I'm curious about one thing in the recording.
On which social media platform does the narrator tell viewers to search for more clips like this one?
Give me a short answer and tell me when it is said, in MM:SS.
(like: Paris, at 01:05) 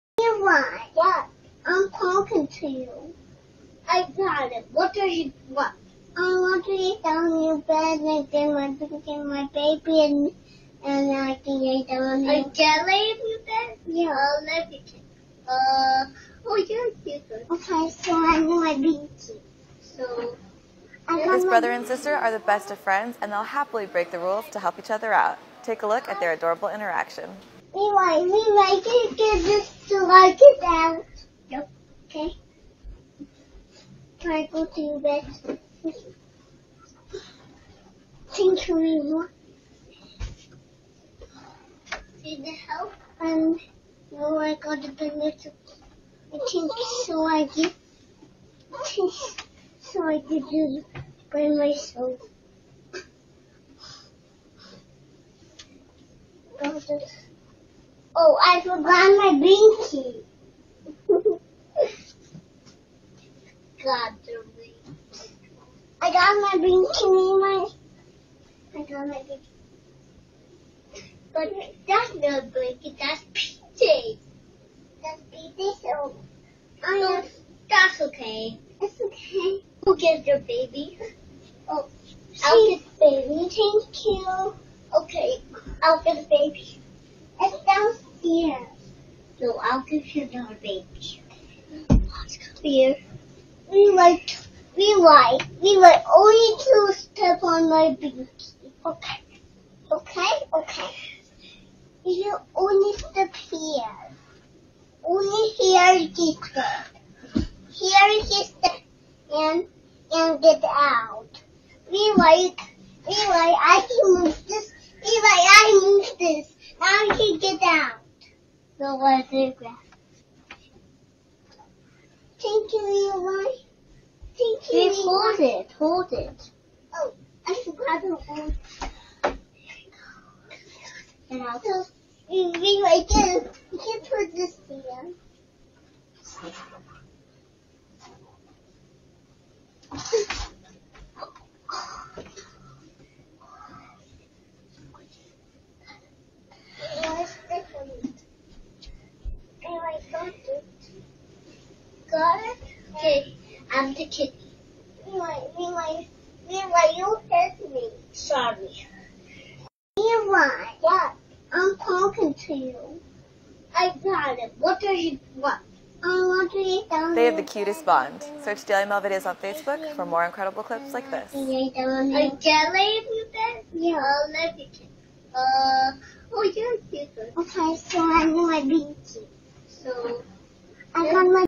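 Facebook, at 02:49.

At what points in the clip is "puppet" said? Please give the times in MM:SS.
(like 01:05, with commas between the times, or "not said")
02:53.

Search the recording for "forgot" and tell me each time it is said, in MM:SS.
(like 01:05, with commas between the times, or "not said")
00:58, 02:07.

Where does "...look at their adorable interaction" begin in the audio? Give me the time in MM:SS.
00:25.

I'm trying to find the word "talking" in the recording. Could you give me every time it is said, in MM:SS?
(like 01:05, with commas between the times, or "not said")
00:01, 02:41.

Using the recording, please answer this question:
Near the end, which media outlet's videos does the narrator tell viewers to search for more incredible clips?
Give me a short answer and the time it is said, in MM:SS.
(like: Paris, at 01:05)
Daily Mail, at 02:48.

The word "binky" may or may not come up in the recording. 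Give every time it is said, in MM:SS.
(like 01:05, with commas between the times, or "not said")
00:59, 01:06.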